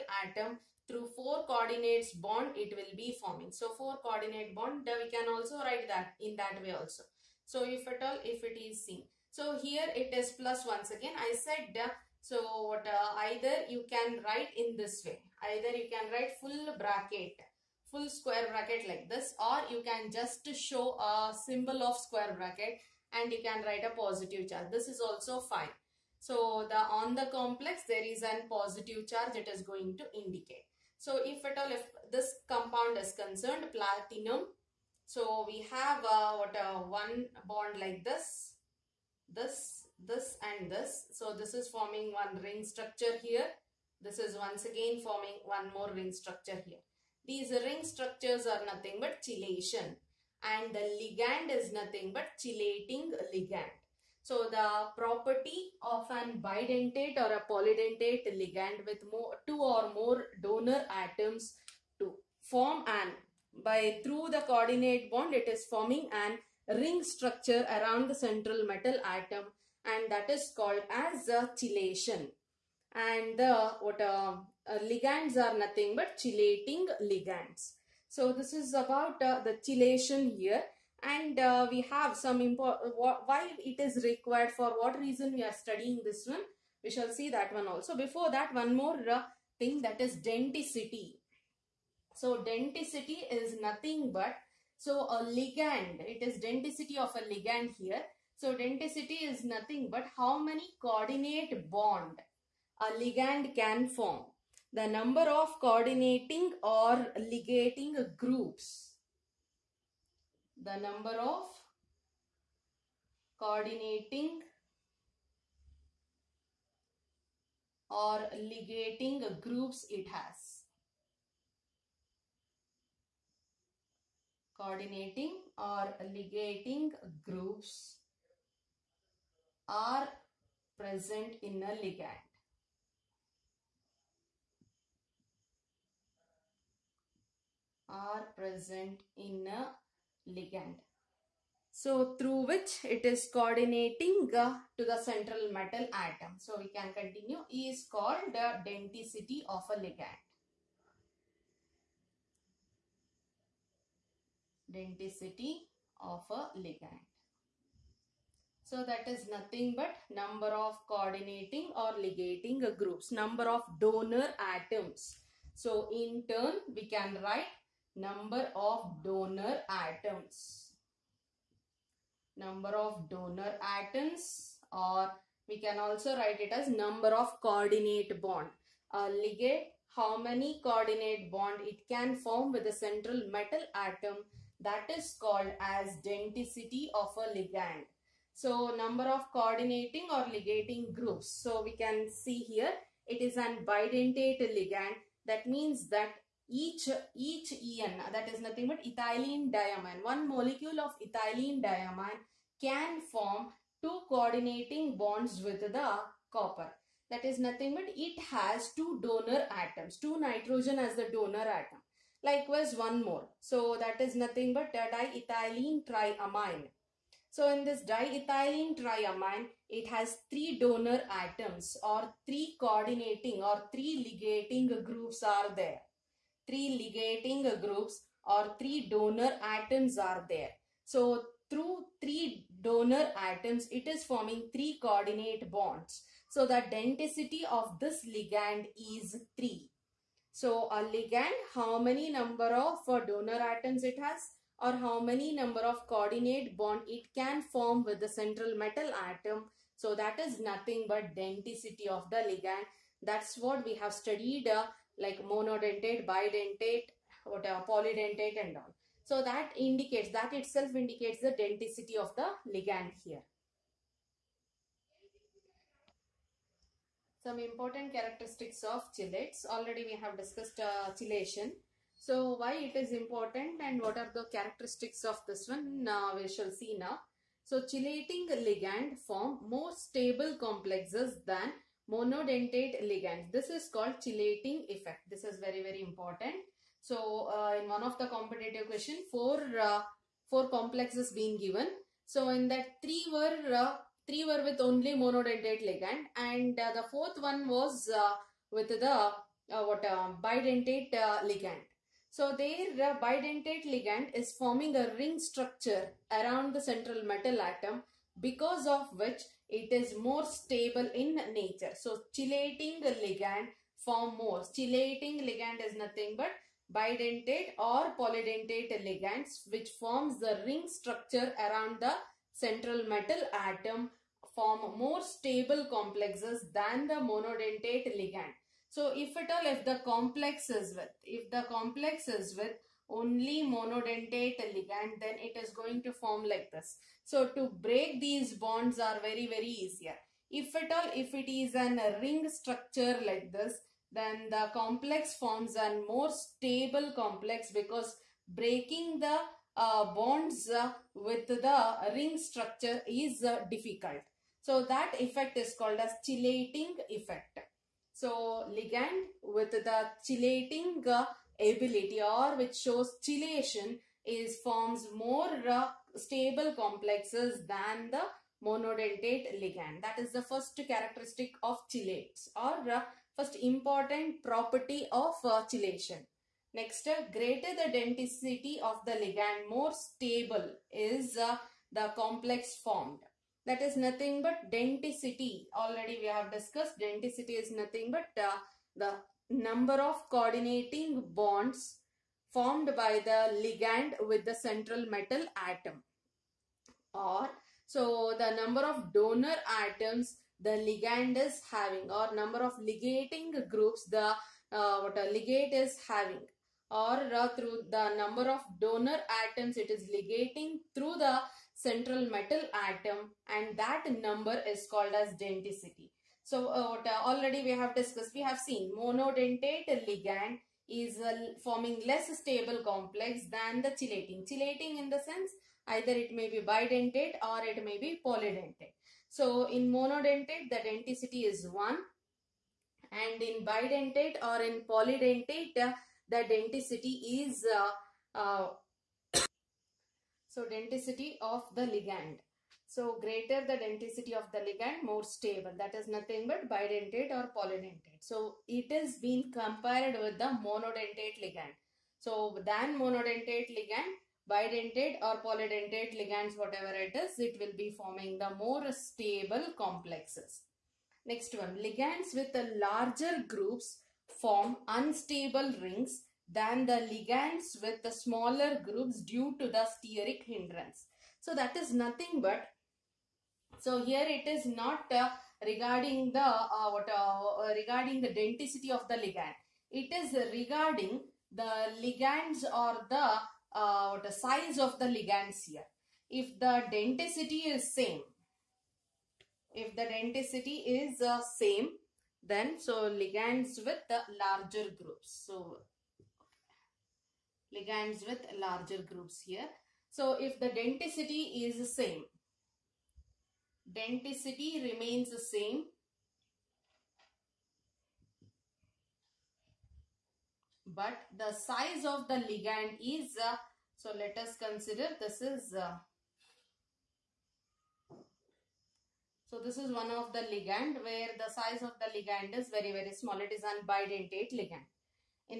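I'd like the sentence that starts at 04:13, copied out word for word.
That's what we have studied uh, like monodentate, bidentate, whatever, polydentate and all.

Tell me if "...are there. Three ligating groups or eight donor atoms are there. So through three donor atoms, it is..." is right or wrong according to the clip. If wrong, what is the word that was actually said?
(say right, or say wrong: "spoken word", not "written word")
wrong: "three", not "eight".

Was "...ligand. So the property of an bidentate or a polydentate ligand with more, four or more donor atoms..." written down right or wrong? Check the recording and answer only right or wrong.
wrong.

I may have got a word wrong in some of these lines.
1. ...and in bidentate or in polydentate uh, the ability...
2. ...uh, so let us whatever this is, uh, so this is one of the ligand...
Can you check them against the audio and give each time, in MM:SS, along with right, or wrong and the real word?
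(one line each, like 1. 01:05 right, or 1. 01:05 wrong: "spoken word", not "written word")
1. 07:12 wrong: "denticity", not "ability"
2. 08:33 wrong: "consider", not "whatever".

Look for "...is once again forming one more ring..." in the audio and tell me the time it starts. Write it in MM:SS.
00:44.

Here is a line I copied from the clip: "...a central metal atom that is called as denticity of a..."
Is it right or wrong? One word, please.
right.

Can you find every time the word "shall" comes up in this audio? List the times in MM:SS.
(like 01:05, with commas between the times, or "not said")
01:26, 04:36.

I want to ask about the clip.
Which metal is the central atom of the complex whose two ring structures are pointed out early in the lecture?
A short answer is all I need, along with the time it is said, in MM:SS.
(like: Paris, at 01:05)
platinum, at 00:33.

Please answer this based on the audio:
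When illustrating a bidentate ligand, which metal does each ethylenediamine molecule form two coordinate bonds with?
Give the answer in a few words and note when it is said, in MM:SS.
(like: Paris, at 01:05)
copper, at 03:26.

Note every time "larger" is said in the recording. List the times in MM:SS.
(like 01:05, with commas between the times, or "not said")
07:42, 08:14, 08:18.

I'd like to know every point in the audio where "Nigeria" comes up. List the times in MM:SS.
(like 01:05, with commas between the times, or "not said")
not said.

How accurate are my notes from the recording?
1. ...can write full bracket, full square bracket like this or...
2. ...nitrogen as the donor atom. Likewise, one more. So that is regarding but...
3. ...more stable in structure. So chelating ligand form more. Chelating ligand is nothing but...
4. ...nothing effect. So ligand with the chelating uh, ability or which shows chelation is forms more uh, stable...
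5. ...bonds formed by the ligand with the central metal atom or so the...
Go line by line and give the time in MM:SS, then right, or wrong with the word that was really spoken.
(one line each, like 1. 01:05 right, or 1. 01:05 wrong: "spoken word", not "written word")
1. 00:15 right
2. 03:30 wrong: "nothing", not "regarding"
3. 05:10 wrong: "nature", not "structure"
4. 05:56 wrong: "chelating", not "nothing"
5. 06:31 right.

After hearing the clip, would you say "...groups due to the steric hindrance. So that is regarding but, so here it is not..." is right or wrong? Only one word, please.
wrong.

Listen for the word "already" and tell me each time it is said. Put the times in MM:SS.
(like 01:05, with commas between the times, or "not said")
04:29, 06:25, 06:57.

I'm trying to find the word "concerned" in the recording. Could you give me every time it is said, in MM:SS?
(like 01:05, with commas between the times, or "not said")
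00:33.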